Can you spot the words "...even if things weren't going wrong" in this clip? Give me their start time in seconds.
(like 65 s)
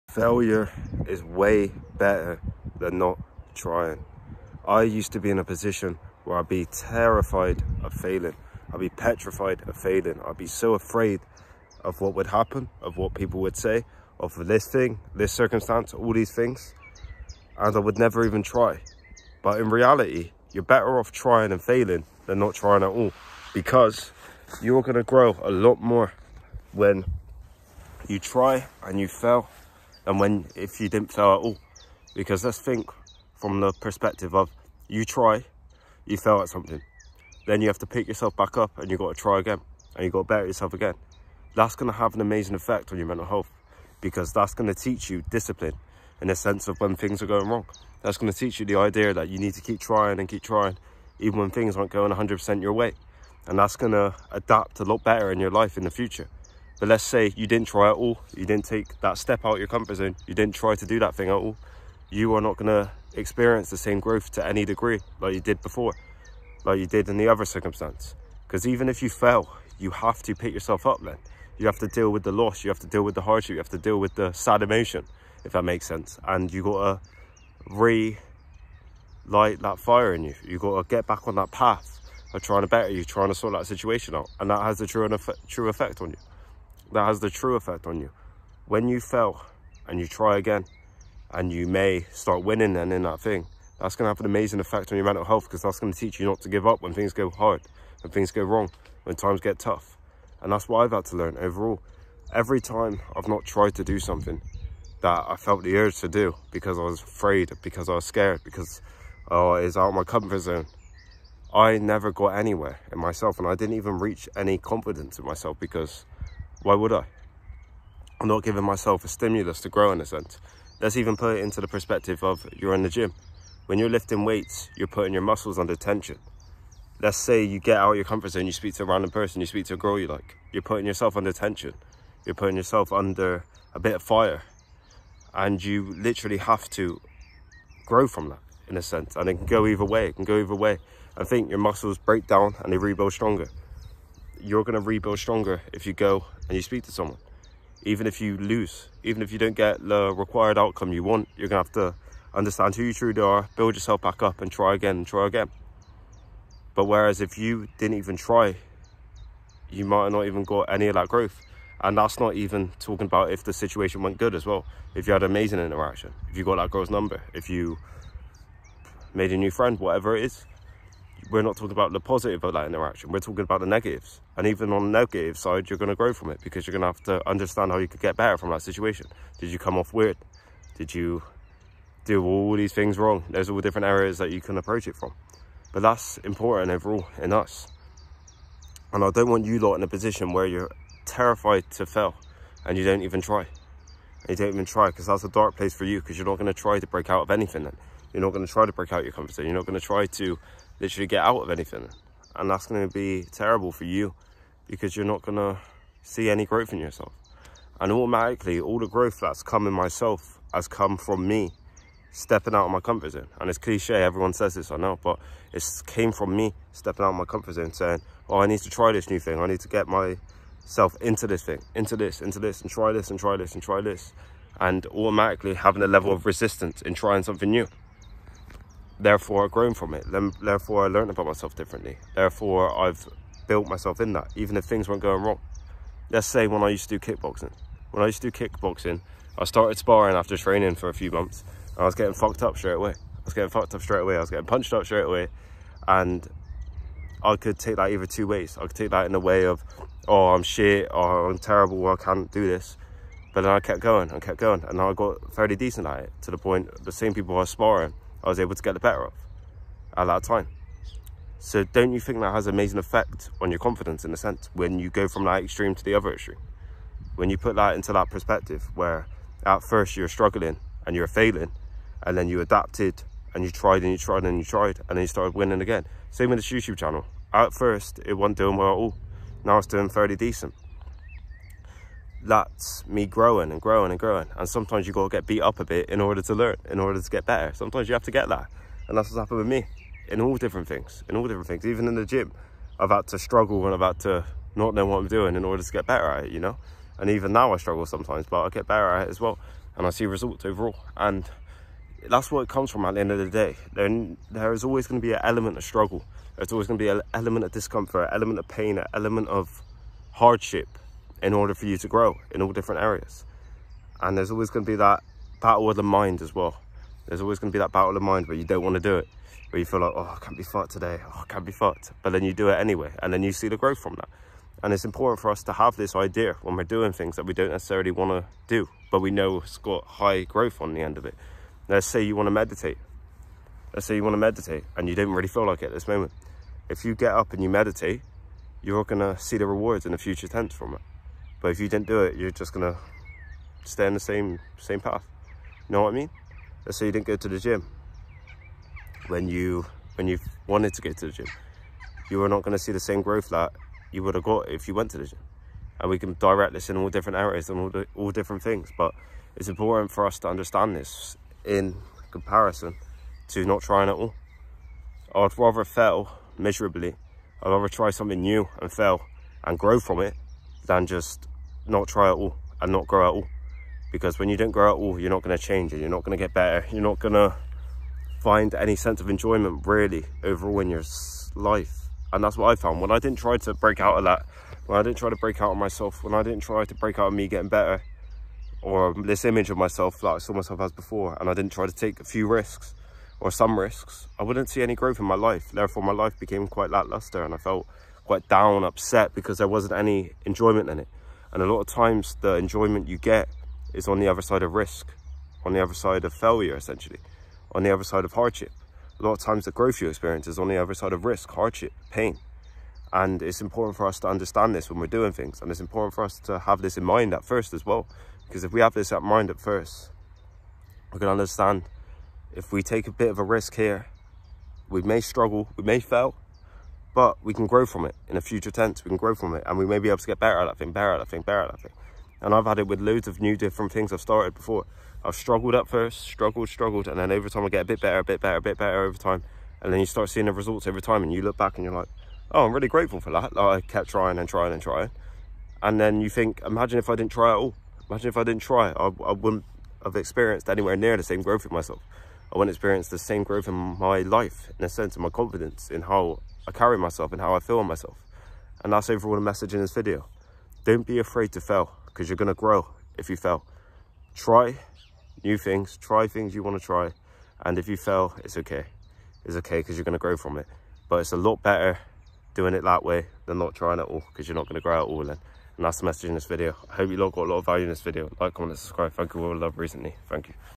234 s.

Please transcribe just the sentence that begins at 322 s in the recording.
But then you do it anyway, and then you see the growth from that.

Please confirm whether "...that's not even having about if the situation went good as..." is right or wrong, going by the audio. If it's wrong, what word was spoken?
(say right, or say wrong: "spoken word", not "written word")
wrong: "talking", not "having".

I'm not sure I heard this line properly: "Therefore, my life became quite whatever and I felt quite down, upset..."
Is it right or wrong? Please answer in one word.
wrong.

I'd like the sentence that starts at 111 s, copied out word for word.
I never got anywhere in myself and I didn't even reach any confidence in myself because why would I?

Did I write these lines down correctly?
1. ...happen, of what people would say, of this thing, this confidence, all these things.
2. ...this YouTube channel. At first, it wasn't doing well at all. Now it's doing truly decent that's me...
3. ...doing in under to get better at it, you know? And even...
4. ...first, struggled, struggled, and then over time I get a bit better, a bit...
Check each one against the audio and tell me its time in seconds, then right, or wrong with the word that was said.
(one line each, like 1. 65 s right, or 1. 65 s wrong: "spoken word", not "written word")
1. 12 s wrong: "circumstance", not "confidence"
2. 276 s wrong: "fairly", not "truly"
3. 295 s wrong: "order", not "under"
4. 435 s right.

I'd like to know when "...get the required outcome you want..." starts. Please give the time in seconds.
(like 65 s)
149 s.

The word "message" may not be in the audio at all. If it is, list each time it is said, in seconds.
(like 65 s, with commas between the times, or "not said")
459 s, 475 s.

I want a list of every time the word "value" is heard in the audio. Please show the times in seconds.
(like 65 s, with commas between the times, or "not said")
477 s.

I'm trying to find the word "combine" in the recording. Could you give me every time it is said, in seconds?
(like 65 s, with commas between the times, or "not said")
not said.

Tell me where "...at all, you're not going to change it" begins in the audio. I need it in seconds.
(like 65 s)
374 s.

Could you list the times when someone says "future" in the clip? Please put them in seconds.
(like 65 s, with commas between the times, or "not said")
55 s, 339 s, 428 s.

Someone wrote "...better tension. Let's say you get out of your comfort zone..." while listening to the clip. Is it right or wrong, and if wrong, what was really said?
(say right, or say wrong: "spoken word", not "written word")
wrong: "under", not "better".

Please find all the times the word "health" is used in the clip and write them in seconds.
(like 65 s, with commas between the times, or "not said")
43 s, 95 s.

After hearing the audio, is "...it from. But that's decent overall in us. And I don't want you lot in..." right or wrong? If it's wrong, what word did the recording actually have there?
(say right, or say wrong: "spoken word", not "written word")
wrong: "important", not "decent".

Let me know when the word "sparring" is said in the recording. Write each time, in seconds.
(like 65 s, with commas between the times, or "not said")
239 s, 257 s.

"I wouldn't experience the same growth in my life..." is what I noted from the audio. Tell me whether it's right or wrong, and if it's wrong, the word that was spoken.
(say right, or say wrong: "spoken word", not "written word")
right.